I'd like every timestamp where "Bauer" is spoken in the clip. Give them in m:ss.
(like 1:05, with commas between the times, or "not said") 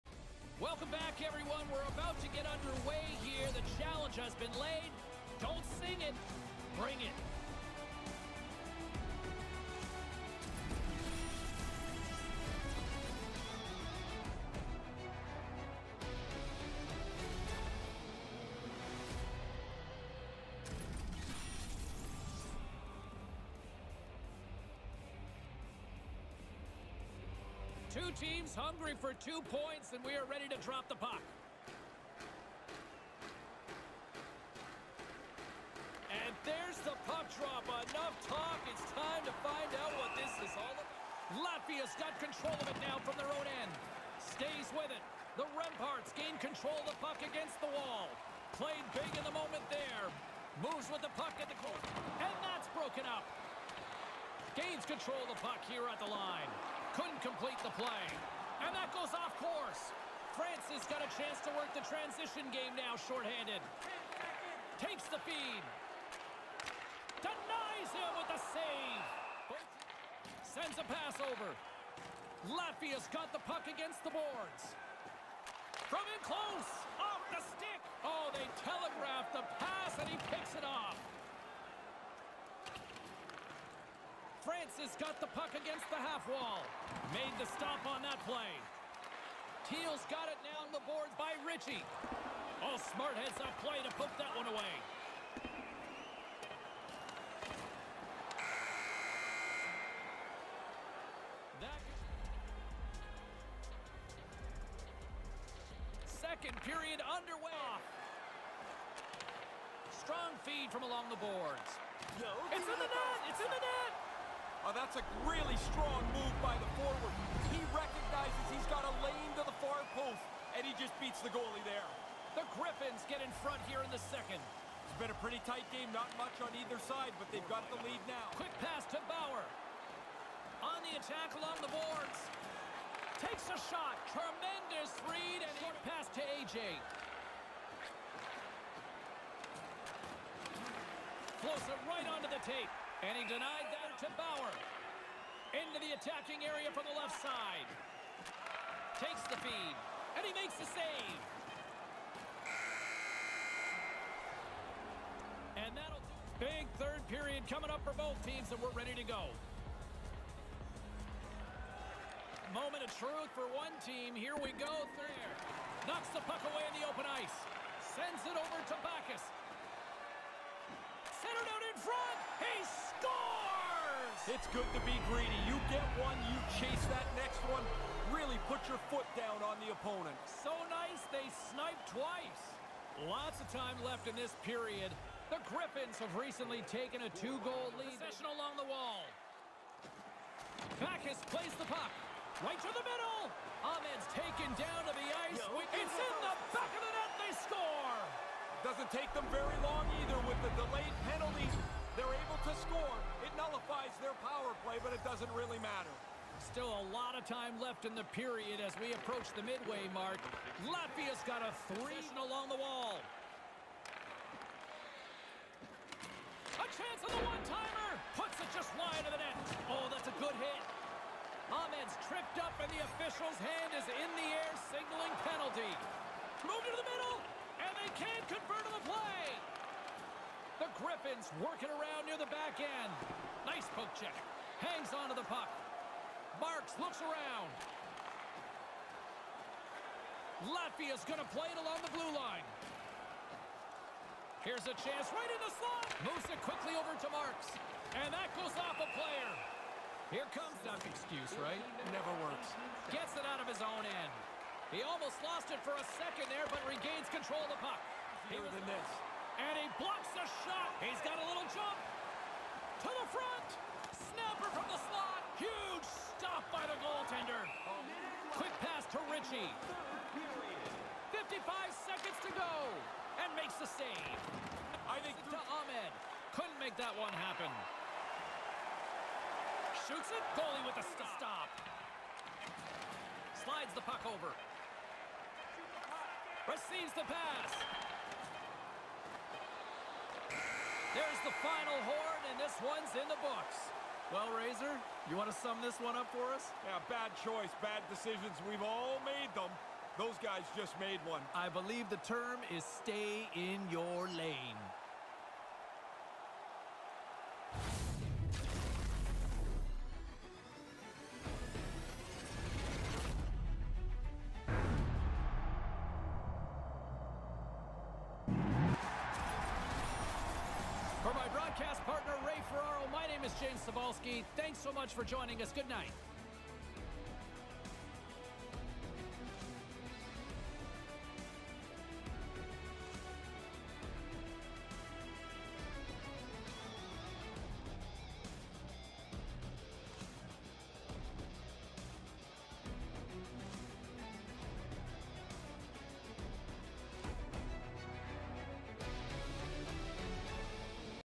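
2:09, 2:24.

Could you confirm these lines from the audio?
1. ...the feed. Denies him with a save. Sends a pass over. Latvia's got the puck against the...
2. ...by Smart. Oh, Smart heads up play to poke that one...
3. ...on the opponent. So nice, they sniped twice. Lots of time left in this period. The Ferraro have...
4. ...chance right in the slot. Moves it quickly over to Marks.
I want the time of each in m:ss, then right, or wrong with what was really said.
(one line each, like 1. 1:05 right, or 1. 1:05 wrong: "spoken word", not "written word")
1. 1:05 right
2. 1:31 wrong: "Ritchie", not "Smart"
3. 2:59 wrong: "Griffins", not "Ferraro"
4. 4:04 right.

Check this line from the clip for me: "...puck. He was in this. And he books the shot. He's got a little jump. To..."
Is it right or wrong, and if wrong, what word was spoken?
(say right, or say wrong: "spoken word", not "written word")
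wrong: "blocks", not "books".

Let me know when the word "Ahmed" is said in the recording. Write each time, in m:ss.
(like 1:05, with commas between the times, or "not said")
3:13, 3:41, 4:35.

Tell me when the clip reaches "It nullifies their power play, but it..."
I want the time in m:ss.
3:23.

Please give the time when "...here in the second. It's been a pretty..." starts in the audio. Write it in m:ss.
2:03.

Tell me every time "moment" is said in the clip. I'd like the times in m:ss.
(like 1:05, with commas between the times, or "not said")
0:49, 2:42.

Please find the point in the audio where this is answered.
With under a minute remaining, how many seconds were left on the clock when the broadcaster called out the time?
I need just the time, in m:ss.
4:31.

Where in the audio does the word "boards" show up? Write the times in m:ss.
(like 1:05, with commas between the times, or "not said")
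1:14, 1:30, 1:51, 2:11.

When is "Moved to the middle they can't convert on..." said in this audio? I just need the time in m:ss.
3:46.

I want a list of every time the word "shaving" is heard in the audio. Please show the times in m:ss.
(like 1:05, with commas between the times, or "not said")
not said.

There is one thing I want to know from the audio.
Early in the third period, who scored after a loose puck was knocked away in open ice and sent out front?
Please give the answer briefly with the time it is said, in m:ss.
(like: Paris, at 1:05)
Bacchus, at 2:48.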